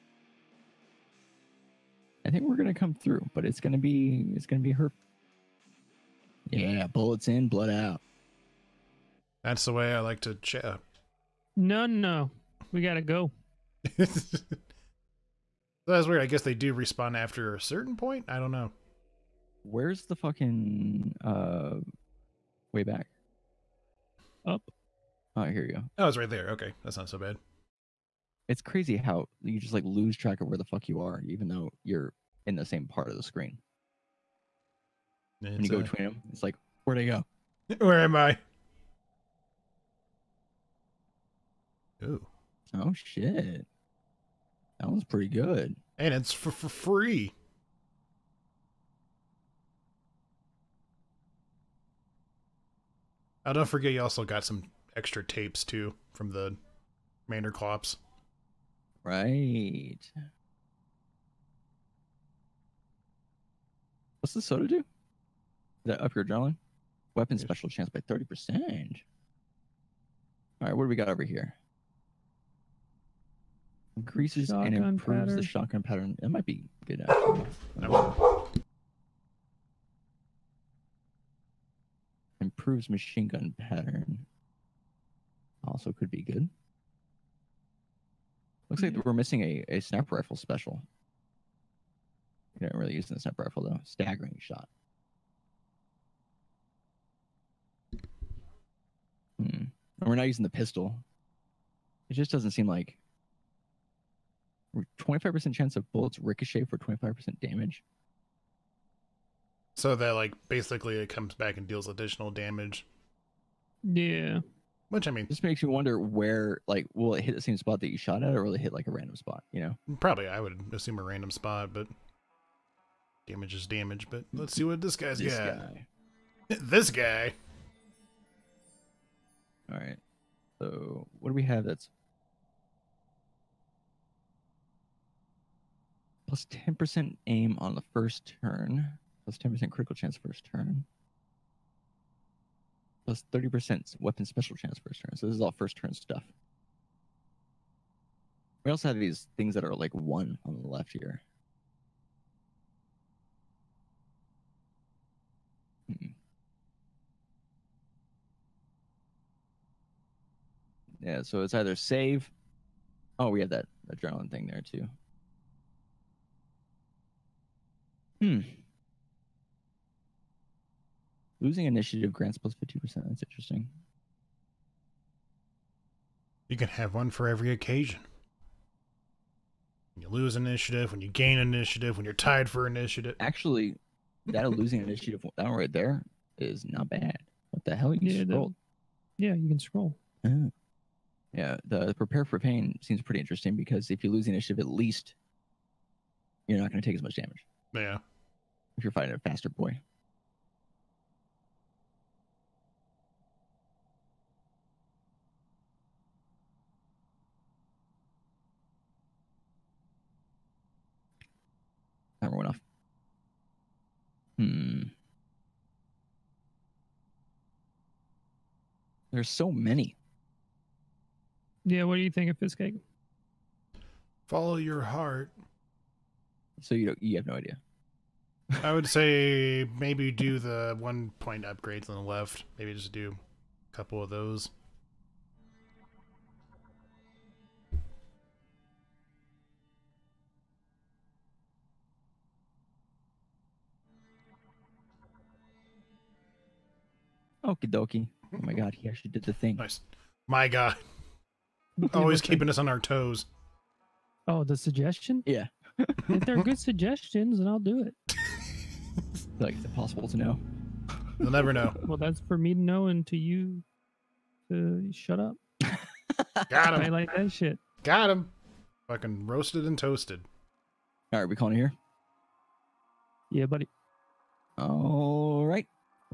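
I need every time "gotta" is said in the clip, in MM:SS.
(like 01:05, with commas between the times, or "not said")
00:12.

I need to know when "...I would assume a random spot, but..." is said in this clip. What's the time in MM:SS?
02:00.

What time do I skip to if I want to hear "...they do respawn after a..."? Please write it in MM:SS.
00:16.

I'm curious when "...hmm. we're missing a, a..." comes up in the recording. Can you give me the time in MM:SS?
01:28.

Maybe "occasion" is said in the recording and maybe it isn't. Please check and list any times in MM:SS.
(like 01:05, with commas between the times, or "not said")
02:57.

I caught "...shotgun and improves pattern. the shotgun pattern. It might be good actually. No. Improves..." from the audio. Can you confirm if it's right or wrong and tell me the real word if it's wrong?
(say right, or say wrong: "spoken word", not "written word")
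right.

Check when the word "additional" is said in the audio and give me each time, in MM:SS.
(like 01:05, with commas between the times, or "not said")
01:51.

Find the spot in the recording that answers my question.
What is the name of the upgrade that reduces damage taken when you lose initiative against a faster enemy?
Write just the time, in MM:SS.
03:11.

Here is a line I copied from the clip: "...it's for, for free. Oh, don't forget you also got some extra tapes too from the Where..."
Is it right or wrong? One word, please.
wrong.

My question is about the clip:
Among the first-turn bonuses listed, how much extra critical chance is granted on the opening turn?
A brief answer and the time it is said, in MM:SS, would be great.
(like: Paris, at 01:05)
10%, at 02:19.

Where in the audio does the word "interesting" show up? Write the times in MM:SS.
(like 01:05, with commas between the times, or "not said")
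02:53, 03:13.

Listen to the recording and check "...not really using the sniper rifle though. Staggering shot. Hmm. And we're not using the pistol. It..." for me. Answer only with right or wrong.
right.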